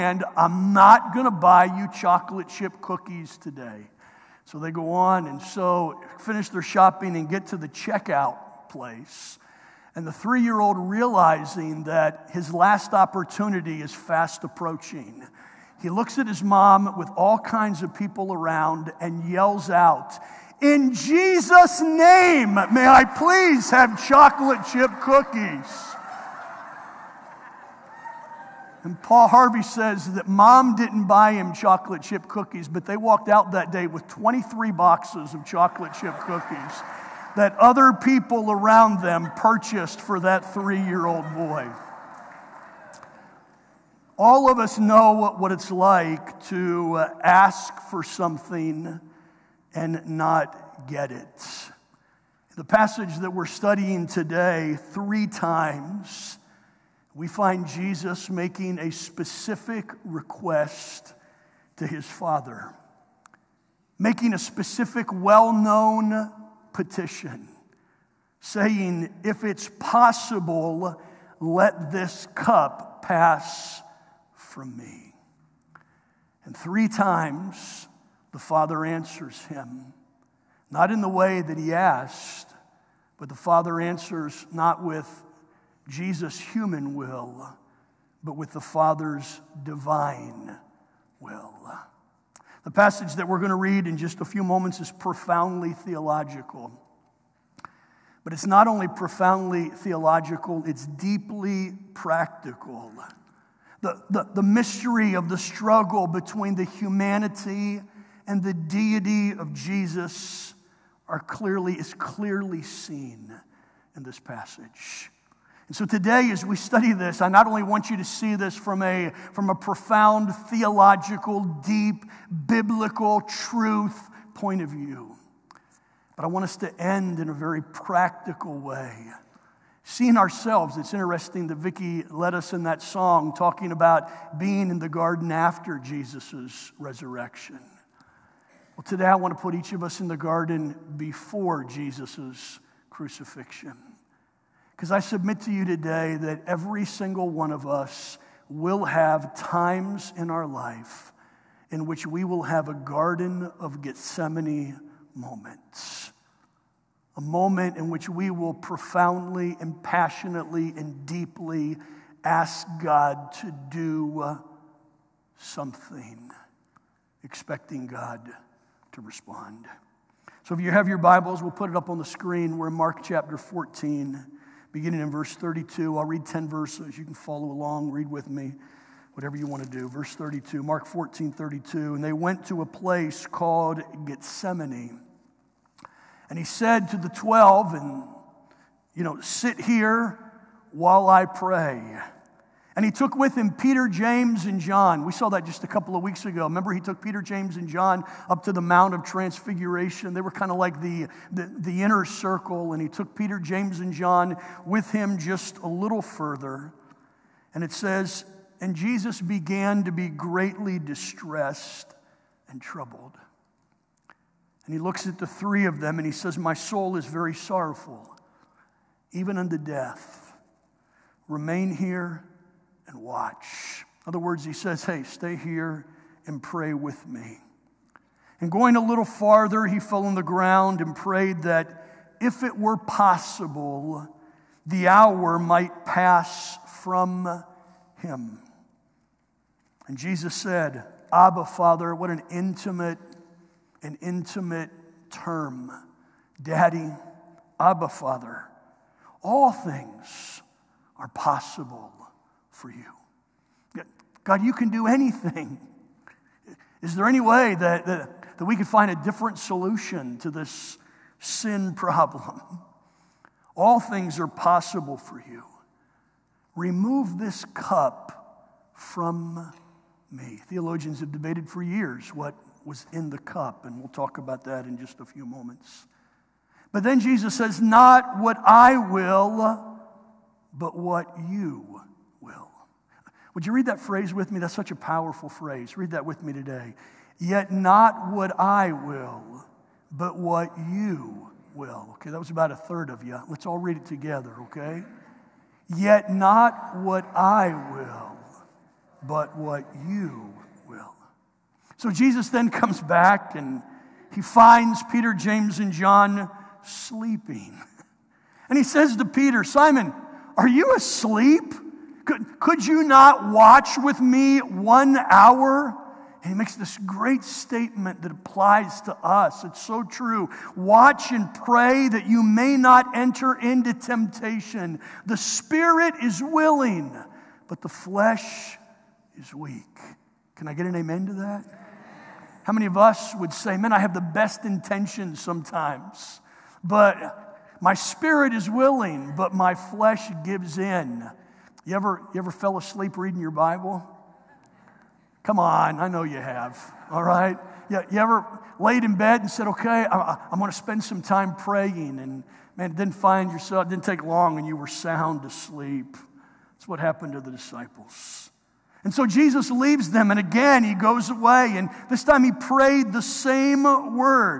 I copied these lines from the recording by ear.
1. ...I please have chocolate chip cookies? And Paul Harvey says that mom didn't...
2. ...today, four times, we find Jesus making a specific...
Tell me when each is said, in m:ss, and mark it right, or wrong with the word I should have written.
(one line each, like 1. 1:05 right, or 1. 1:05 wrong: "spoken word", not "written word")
1. 0:22 right
2. 0:54 wrong: "three", not "four".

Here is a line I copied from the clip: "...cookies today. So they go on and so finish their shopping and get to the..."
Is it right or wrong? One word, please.
right.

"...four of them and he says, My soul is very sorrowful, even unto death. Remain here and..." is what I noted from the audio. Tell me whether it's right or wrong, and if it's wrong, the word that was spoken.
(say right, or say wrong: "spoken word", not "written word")
wrong: "three", not "four".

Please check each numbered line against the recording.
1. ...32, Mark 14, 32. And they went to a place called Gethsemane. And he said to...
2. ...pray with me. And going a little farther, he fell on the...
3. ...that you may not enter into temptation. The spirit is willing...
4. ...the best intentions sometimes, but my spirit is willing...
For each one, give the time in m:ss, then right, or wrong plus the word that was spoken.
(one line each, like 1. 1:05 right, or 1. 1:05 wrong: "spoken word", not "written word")
1. 3:00 right
2. 3:46 right
3. 5:21 right
4. 5:33 right.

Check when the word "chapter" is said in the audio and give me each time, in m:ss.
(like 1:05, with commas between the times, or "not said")
2:53.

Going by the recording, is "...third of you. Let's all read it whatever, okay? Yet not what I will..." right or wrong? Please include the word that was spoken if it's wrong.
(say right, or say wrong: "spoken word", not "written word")
wrong: "together", not "whatever".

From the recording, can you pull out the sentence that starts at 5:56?
That's what happened to the disciples.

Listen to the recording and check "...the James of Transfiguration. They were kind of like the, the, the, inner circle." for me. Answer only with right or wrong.
wrong.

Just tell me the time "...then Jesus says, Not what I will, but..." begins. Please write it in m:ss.
4:36.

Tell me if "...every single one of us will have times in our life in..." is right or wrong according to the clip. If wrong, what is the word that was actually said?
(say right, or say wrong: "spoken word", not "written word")
right.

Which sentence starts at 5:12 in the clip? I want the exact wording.
Could, could you not watch with me one hour?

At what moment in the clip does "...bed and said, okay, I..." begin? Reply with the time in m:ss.
5:48.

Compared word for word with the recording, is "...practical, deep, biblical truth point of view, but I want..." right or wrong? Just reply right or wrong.
wrong.